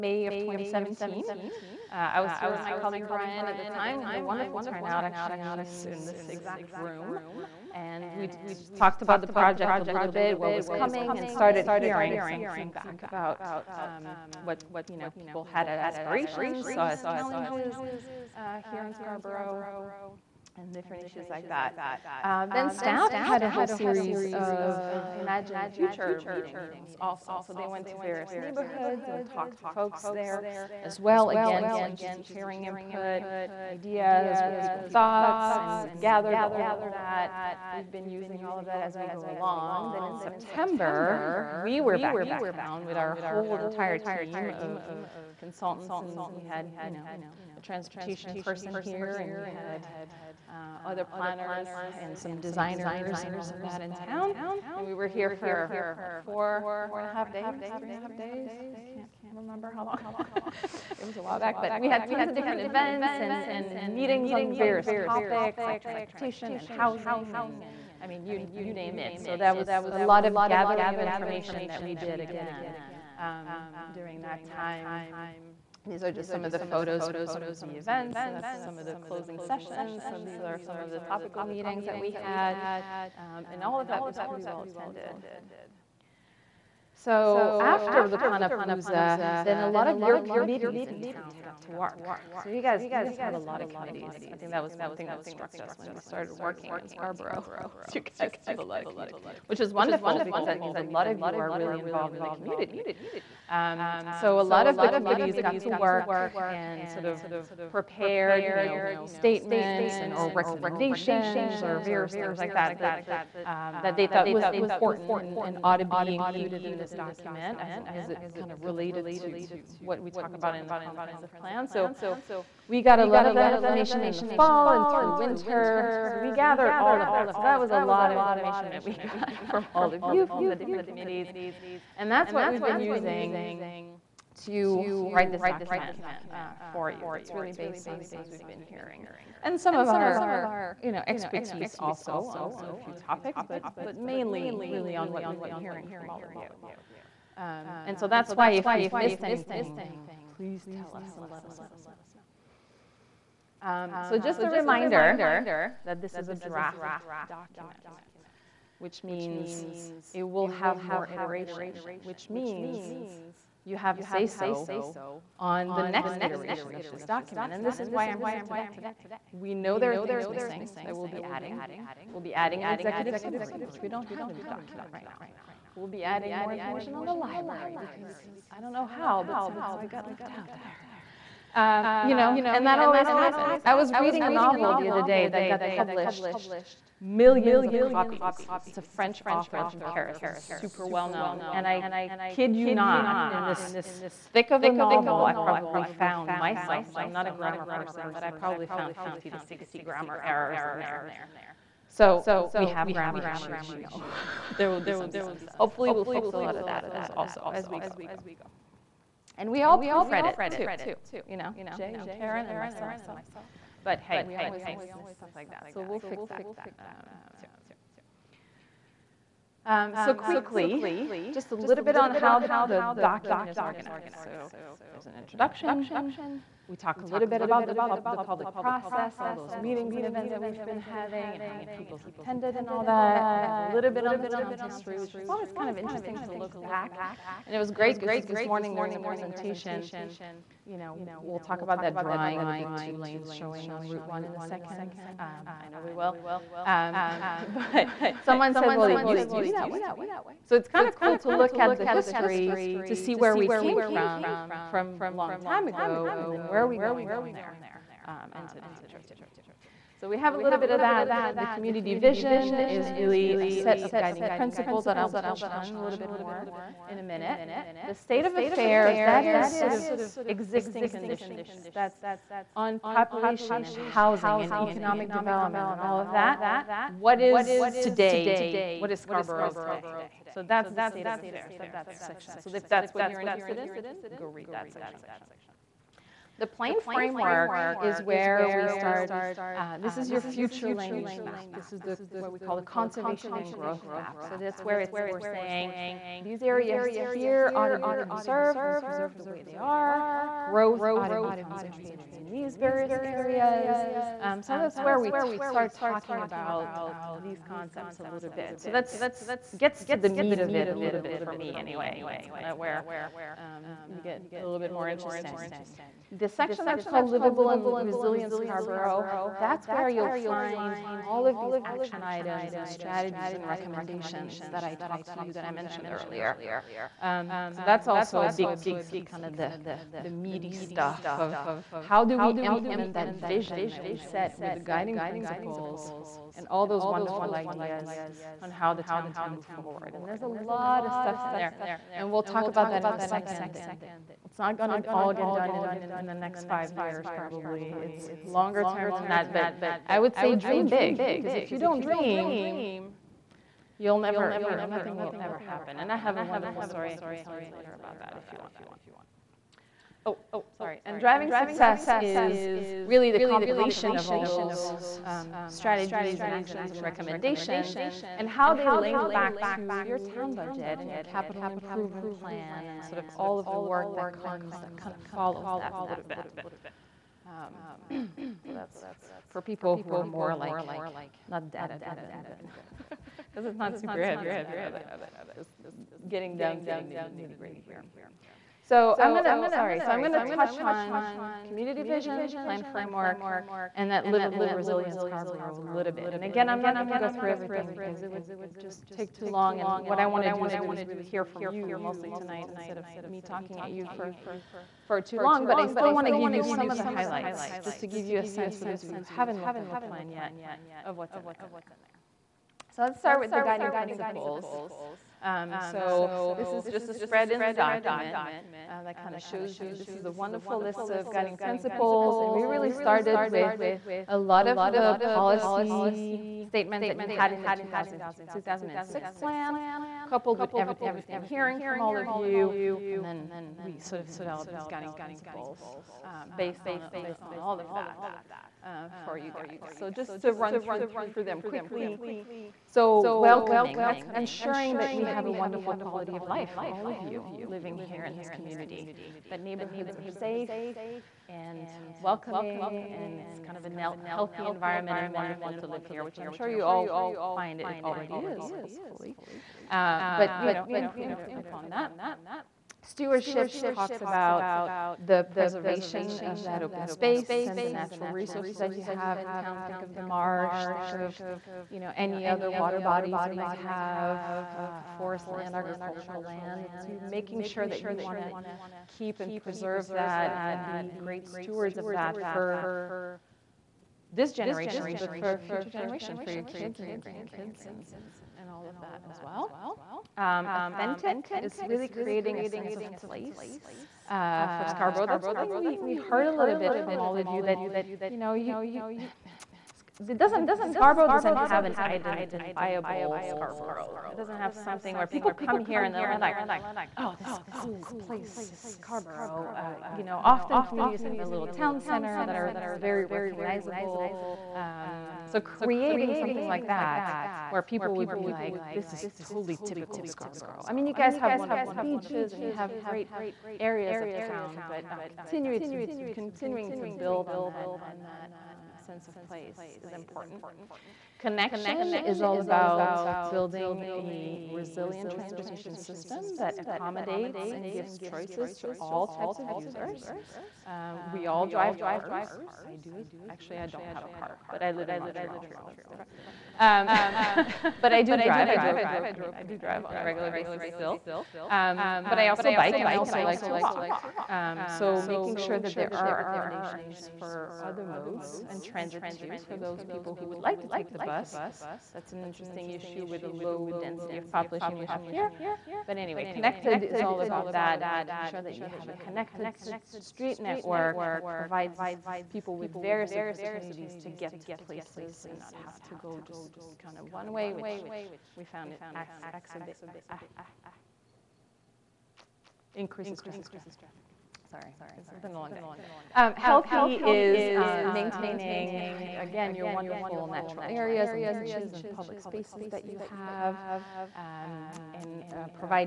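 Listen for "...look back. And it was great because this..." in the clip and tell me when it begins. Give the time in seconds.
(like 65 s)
236 s.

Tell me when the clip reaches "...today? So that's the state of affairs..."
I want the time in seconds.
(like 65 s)
279 s.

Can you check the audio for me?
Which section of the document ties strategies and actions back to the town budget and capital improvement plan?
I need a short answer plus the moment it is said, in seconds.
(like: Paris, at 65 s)
Driving success, at 360 s.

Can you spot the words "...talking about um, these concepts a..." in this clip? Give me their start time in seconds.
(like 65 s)
305 s.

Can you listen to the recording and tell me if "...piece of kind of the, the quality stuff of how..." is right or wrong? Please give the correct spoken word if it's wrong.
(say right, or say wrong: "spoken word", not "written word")
wrong: "meaty", not "quality".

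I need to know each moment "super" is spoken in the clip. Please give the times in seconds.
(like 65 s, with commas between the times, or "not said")
190 s, 383 s.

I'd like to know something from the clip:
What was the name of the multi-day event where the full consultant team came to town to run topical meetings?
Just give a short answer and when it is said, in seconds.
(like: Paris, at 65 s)
Planapalooza, at 88 s.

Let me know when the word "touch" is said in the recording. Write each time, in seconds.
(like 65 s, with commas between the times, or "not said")
265 s, 390 s.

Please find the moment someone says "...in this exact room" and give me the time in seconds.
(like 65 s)
5 s.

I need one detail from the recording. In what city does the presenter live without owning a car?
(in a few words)
Montreal.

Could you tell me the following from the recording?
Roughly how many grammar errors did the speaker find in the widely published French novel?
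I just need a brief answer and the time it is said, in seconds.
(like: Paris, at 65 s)
50 to 60, at 198 s.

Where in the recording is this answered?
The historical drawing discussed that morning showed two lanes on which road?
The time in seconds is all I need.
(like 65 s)
243 s.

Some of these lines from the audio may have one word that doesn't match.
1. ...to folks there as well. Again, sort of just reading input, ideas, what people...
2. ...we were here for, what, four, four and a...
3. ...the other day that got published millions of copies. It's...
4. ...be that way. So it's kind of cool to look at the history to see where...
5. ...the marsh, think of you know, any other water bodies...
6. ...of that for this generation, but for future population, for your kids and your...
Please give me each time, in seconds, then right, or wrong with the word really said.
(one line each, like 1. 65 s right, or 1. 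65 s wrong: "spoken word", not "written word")
1. 29 s wrong: "hearing", not "reading"
2. 54 s right
3. 184 s right
4. 249 s right
5. 469 s right
6. 481 s wrong: "generation", not "population".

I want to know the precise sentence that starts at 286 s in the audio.
The plain framework is where we start.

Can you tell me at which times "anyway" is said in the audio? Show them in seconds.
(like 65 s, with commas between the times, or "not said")
311 s, 565 s.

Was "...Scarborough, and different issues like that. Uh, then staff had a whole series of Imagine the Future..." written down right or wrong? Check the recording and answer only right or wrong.
right.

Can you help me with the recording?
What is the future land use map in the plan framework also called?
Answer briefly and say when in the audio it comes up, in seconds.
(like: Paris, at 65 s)
Conservation and growth map, at 292 s.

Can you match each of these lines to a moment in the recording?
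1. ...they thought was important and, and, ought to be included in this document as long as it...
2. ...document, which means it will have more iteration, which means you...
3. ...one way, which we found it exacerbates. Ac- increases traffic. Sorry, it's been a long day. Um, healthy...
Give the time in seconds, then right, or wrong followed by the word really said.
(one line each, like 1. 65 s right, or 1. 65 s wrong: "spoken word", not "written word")
1. 113 s right
2. 157 s right
3. 577 s right.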